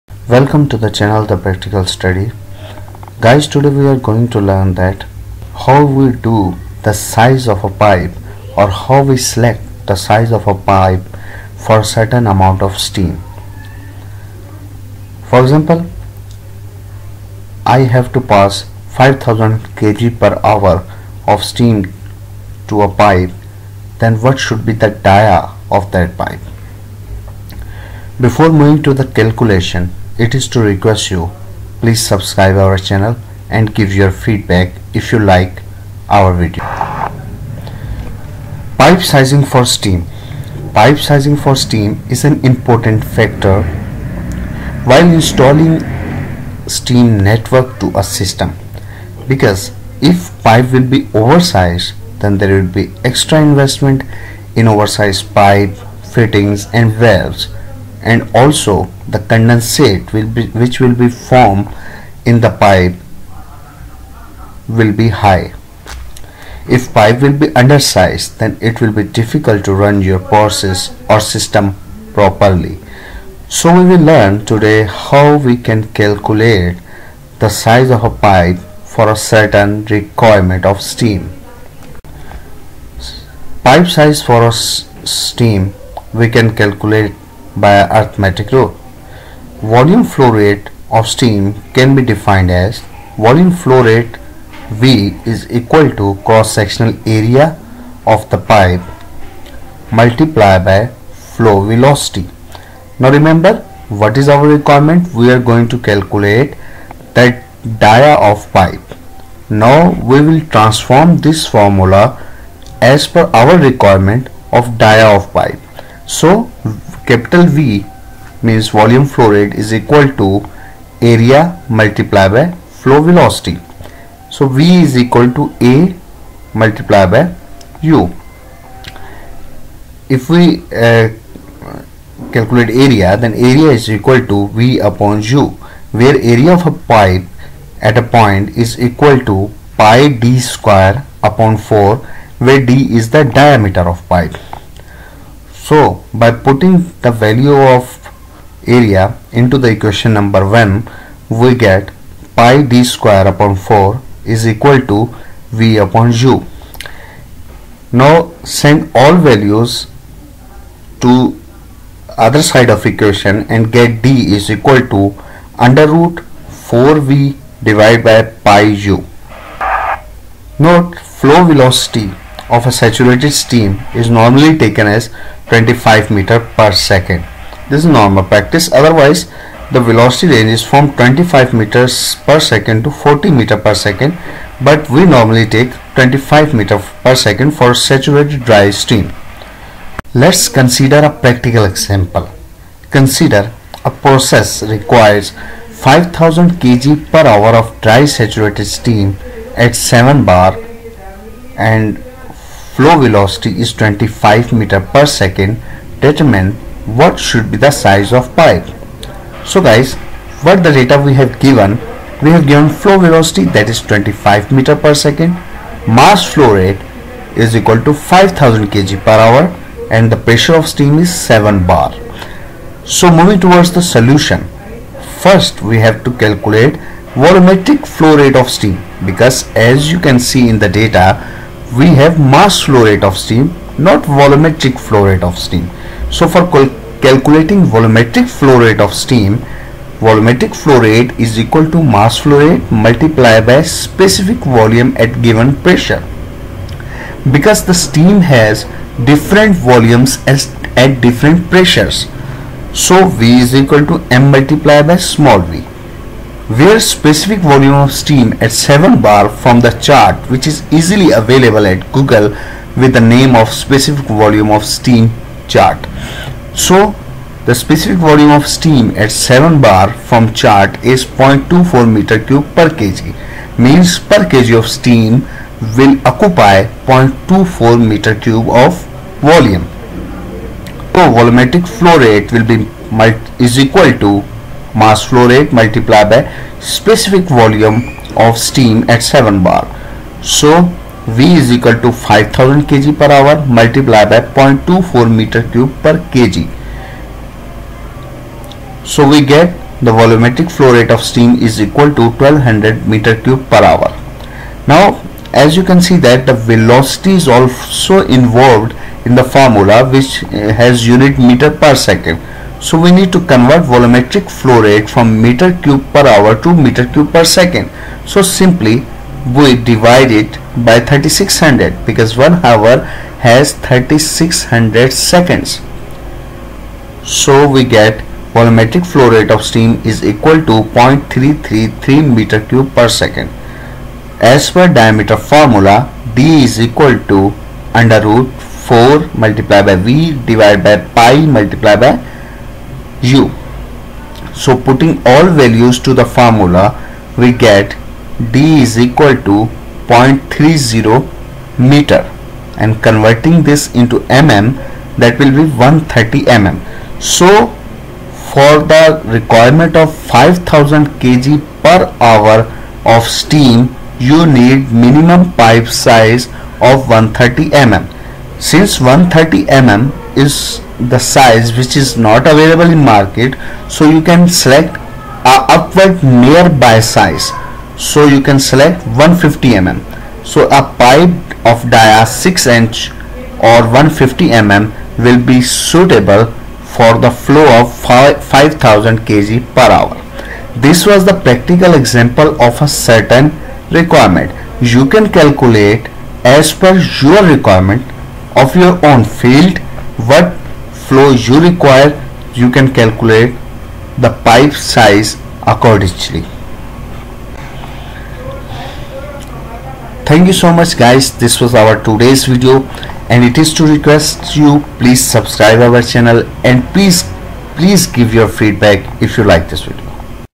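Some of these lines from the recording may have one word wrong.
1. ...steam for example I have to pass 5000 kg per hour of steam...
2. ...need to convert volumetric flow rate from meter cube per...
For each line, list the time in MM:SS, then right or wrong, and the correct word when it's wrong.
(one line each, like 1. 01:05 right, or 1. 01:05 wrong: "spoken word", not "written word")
1. 00:12 right
2. 05:12 right.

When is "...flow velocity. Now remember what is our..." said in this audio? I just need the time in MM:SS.
01:41.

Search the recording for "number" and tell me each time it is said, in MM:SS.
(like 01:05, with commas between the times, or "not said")
02:30.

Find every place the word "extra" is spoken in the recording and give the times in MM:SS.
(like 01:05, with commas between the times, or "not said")
00:53.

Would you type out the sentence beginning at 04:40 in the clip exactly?
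So volumetric flow rate will be is equal to mass flow rate multiplied by specific volume of steam at 7 bar.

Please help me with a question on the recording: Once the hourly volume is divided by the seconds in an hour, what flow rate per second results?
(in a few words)
0.333 cubic meters per second.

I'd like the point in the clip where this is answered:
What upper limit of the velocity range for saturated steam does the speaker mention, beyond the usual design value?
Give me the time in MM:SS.
03:02.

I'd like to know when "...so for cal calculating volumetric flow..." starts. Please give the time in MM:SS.
03:56.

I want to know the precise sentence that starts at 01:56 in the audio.
So capital V means volume flow rate is equal to area multiplied by flow velocity.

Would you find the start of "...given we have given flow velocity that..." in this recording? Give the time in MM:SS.
03:31.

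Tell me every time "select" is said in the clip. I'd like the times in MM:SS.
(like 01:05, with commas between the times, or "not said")
00:09, 06:14, 06:18.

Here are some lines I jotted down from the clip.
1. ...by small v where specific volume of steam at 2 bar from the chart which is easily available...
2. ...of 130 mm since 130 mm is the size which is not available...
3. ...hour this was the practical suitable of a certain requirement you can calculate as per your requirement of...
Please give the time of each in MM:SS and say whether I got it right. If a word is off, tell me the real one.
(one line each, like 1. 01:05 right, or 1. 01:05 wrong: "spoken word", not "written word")
1. 04:14 wrong: "7", not "2"
2. 06:06 right
3. 06:29 wrong: "example", not "suitable".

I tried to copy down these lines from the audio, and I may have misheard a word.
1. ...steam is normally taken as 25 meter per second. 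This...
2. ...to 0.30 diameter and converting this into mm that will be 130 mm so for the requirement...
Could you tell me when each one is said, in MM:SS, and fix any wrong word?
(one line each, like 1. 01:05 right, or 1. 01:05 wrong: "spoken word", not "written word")
1. 02:53 right
2. 05:49 wrong: "meter", not "diameter".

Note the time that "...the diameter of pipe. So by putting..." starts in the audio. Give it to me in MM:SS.
02:23.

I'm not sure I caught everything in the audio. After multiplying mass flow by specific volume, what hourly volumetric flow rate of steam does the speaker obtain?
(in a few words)
1200 cubic meters per hour.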